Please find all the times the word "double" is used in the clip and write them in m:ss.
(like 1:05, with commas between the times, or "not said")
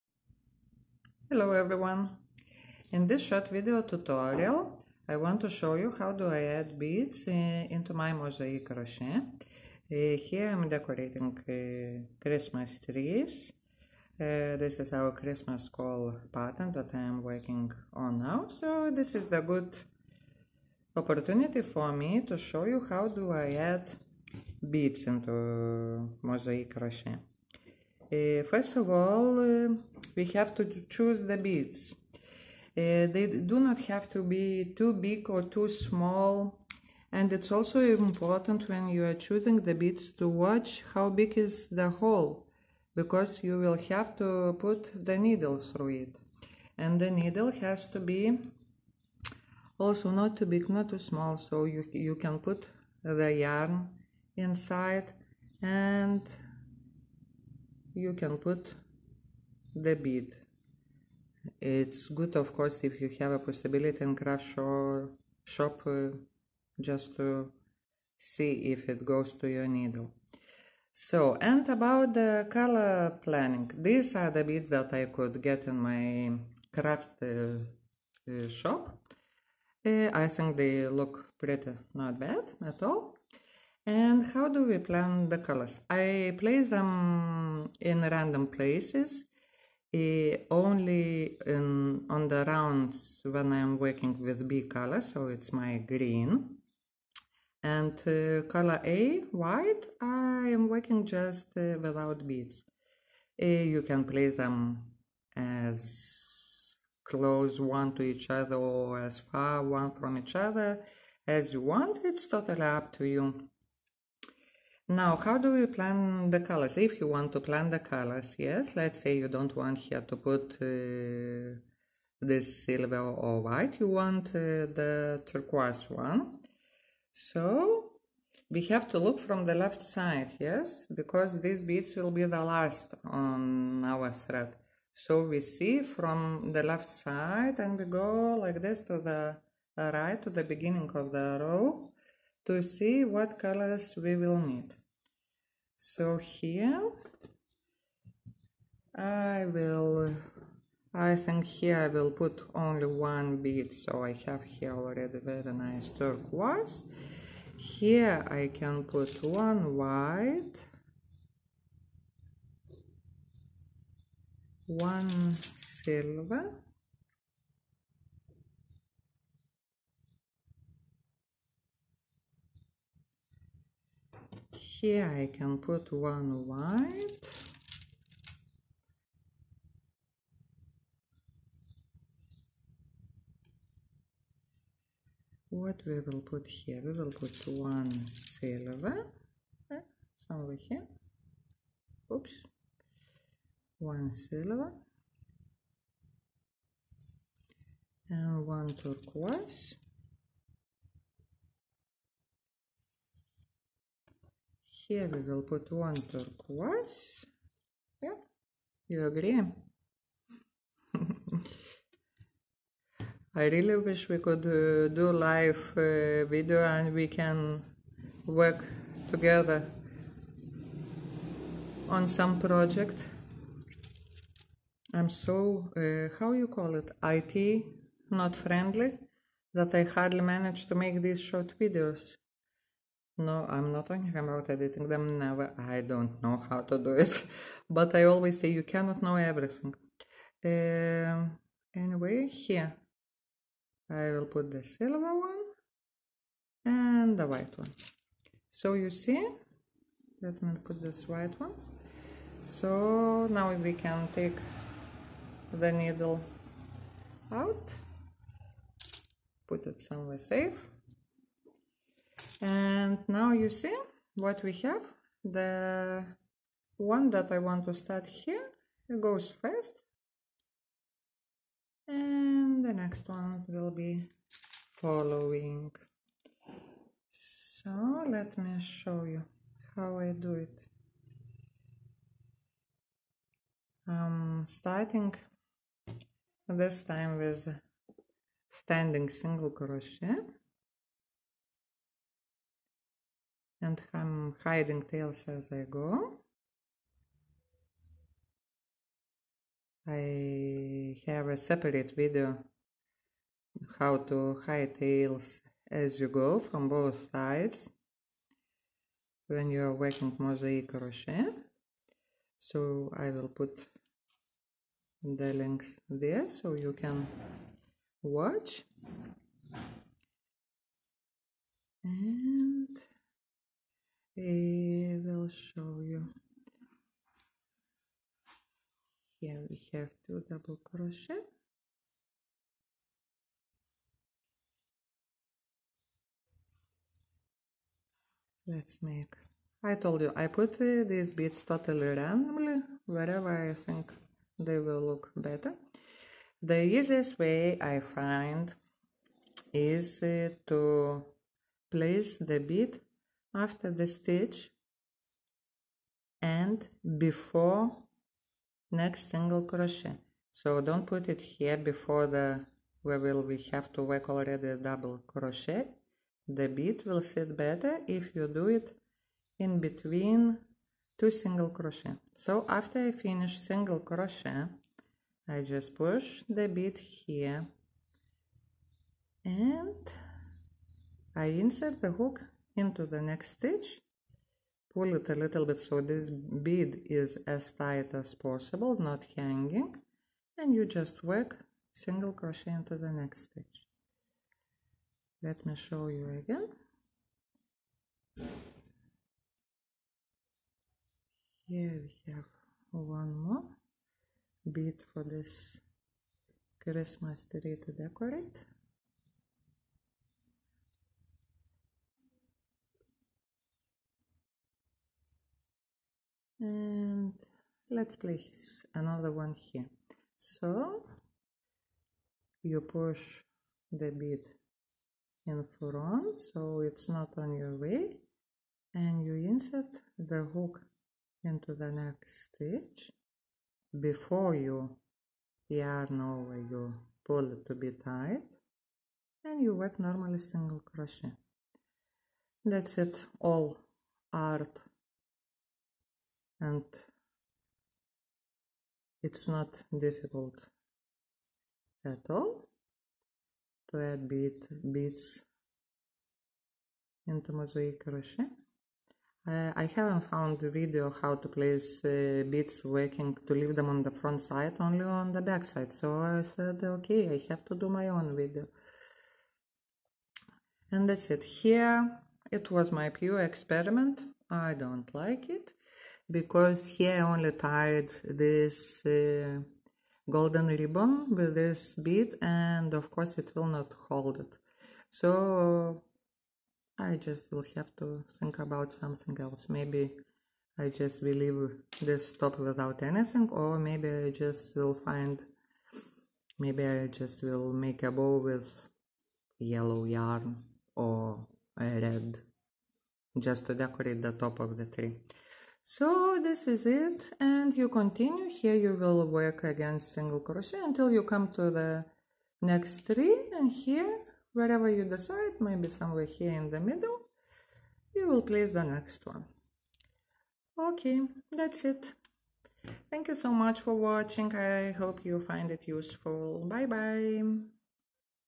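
5:30, 6:04.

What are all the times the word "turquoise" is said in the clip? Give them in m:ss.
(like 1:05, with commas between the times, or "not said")
2:05, 2:35, 3:18, 3:26.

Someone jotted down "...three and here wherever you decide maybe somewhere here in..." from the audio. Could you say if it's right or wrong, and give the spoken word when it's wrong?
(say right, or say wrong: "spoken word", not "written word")
right.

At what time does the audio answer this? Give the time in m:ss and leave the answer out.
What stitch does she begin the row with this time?
4:48.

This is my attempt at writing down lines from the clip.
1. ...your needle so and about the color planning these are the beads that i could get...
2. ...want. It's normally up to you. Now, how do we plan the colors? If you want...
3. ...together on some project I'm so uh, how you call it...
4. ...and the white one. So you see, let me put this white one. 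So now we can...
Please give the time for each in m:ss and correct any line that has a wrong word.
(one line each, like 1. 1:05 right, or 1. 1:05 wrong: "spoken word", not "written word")
1. 1:09 right
2. 1:51 wrong: "totally", not "normally"
3. 3:39 right
4. 4:06 right.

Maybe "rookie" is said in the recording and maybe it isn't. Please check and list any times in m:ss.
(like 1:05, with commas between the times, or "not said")
not said.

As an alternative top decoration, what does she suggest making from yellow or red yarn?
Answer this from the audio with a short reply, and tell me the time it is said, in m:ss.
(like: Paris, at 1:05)
a bow, at 8:17.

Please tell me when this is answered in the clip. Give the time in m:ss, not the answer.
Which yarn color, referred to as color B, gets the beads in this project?
1:35.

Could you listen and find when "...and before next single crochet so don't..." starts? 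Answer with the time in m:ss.
5:56.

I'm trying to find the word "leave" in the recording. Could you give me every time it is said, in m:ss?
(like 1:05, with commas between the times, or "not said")
7:43, 8:11.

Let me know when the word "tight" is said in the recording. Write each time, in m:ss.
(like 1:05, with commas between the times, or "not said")
6:27, 7:17.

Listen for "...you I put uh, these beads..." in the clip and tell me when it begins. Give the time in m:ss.
5:40.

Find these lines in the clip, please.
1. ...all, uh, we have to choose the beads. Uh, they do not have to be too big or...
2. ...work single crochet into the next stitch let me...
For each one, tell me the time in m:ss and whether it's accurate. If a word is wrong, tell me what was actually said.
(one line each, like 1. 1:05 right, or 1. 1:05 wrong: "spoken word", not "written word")
1. 0:28 right
2. 6:31 right.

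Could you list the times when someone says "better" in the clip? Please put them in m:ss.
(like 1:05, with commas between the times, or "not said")
5:45, 6:07.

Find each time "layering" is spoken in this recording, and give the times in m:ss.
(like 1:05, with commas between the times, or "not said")
not said.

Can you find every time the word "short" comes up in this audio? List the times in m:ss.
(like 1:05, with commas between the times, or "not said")
0:03, 3:51.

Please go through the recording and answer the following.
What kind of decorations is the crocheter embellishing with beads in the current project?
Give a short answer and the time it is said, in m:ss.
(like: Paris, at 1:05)
Christmas trees, at 0:12.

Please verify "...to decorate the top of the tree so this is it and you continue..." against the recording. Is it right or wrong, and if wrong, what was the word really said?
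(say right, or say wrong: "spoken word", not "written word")
right.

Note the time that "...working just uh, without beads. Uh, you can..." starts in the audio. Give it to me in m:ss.
1:40.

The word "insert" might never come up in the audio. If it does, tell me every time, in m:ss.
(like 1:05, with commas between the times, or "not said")
6:21, 7:09.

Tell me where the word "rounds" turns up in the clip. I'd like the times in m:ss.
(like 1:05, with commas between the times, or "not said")
1:32.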